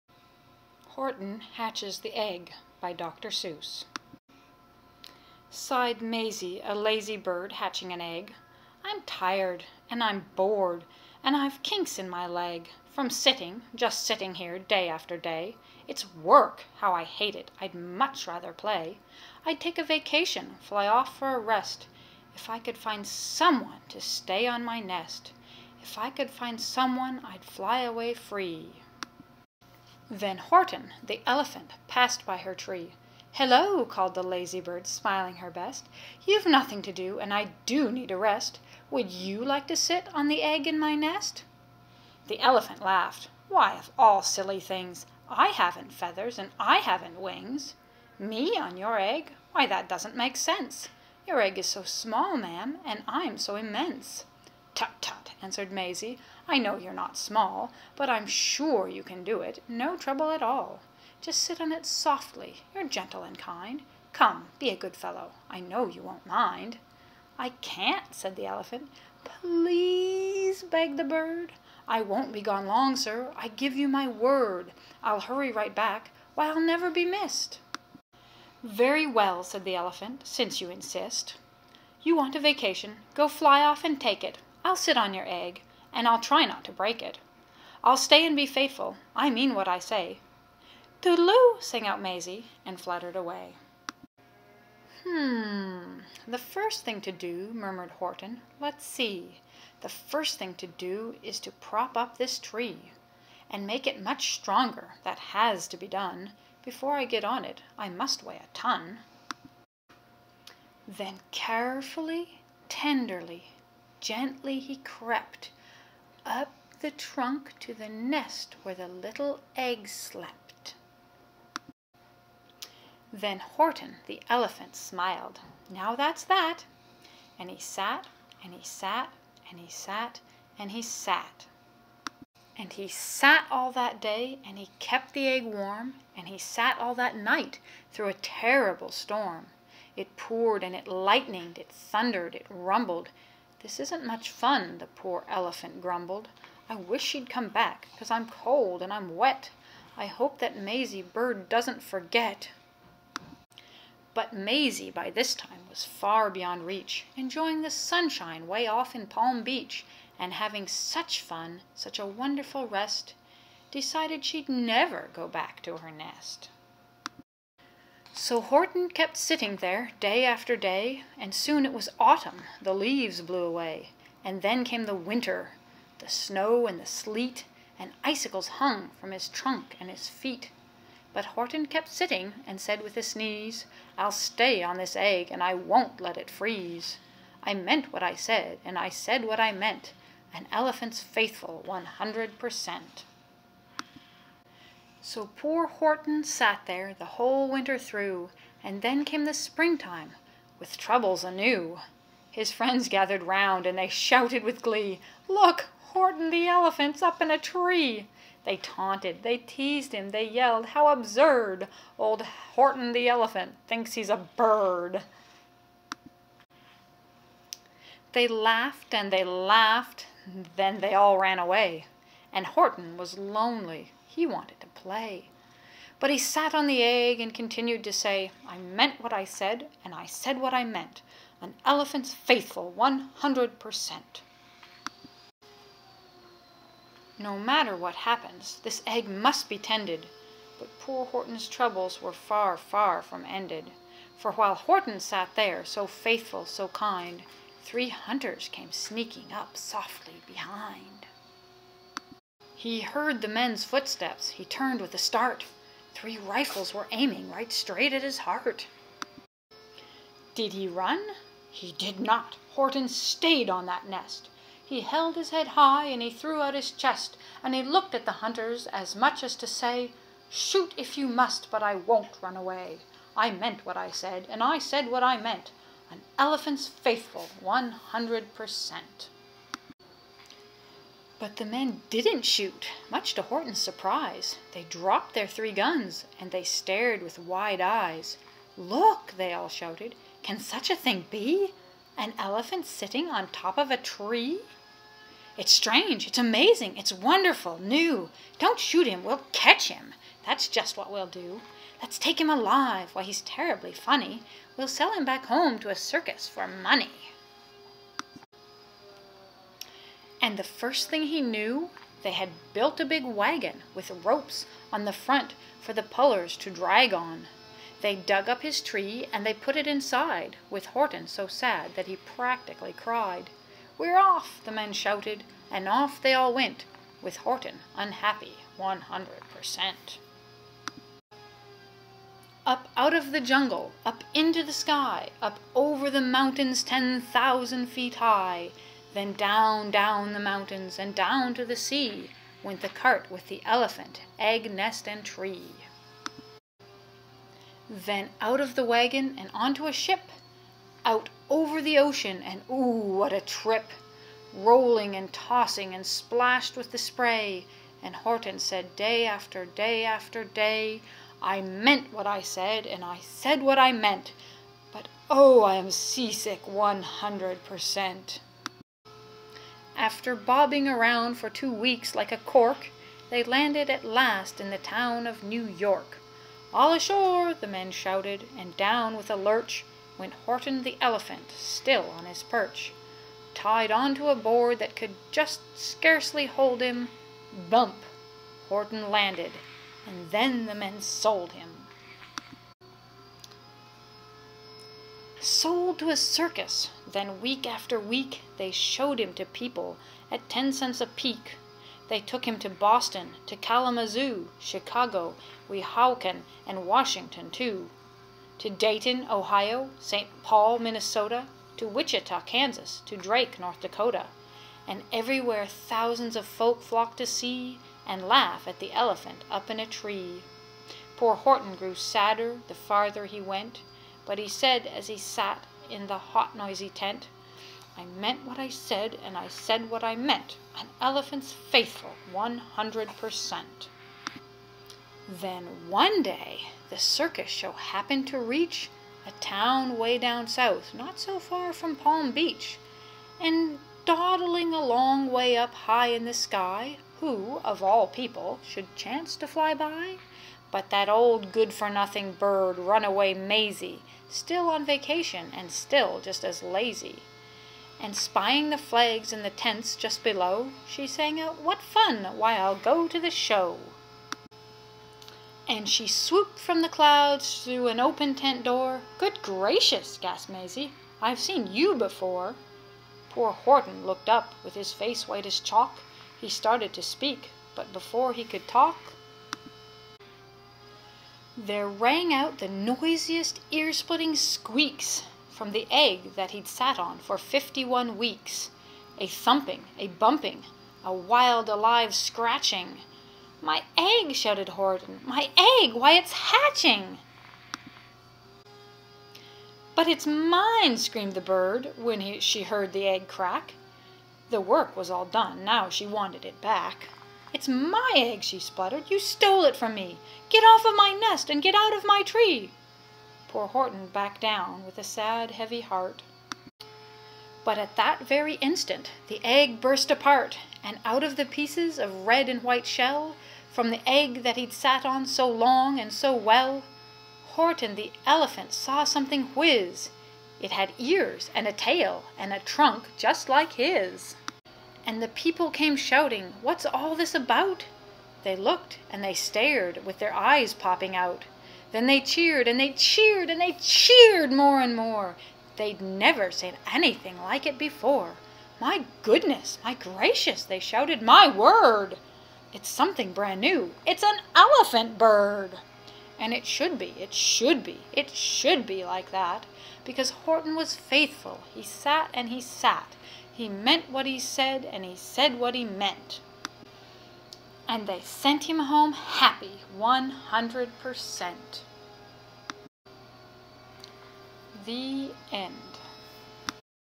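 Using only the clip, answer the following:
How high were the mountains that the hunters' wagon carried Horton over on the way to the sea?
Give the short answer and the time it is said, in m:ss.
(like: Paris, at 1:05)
10,000 feet, at 5:36.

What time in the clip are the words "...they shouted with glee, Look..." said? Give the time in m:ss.
3:23.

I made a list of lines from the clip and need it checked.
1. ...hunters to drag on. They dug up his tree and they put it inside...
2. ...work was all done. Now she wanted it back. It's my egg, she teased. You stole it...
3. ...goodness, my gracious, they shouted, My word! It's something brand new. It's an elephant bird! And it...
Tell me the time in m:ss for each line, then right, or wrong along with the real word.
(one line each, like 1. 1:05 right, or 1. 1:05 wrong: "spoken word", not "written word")
1. 5:15 wrong: "pullers", not "hunters"
2. 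8:24 wrong: "spluttered", not "teased"
3. 9:09 right.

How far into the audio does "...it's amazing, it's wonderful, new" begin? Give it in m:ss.
4:56.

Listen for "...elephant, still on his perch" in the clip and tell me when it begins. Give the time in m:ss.
6:20.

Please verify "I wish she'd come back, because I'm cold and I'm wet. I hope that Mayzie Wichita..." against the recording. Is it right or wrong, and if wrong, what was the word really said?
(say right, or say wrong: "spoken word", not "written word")
wrong: "Bird", not "Wichita".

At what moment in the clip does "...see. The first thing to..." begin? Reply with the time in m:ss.
1:38.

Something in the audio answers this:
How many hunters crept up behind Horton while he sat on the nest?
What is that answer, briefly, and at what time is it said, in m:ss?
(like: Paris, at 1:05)
3, at 4:07.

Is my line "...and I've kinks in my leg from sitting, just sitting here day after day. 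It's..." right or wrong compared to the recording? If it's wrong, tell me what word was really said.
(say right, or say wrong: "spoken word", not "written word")
right.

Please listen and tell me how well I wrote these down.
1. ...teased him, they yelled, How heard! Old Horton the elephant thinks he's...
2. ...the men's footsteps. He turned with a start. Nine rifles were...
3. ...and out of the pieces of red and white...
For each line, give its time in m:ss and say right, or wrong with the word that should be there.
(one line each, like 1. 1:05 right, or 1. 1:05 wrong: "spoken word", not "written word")
1. 3:29 wrong: "absurd", not "heard"
2. 4:13 wrong: "Three", not "Nine"
3. 8:40 right.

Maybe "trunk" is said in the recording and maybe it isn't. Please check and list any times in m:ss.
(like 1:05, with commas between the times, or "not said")
1:56, 2:59, 8:52.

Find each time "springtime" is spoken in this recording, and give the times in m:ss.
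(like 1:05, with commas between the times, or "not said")
3:19.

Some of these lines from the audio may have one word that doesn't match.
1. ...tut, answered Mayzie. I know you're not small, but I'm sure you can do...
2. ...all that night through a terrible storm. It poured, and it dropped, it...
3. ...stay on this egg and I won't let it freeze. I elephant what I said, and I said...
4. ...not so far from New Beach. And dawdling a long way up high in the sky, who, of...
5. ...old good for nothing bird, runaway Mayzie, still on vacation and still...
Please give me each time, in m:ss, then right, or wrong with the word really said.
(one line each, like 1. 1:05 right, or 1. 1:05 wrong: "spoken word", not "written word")
1. 0:54 right
2. 2:16 wrong: "lightened", not "dropped"
3. 3:04 wrong: "meant", not "elephant"
4. 7:20 wrong: "Palm", not "New"
5. 7:30 right.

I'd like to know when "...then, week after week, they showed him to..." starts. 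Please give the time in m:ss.
6:36.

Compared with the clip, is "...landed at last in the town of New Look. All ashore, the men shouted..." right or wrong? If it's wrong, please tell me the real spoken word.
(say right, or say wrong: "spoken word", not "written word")
wrong: "York", not "Look".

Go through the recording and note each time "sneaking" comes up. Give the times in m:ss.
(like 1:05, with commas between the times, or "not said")
4:08.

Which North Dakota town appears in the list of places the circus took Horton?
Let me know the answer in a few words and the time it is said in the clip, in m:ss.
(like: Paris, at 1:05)
Drake, at 6:52.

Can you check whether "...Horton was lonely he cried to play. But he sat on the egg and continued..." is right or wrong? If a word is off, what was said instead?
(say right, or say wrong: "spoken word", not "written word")
wrong: "wanted", not "cried".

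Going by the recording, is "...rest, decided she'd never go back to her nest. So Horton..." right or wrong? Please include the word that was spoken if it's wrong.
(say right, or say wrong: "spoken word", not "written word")
right.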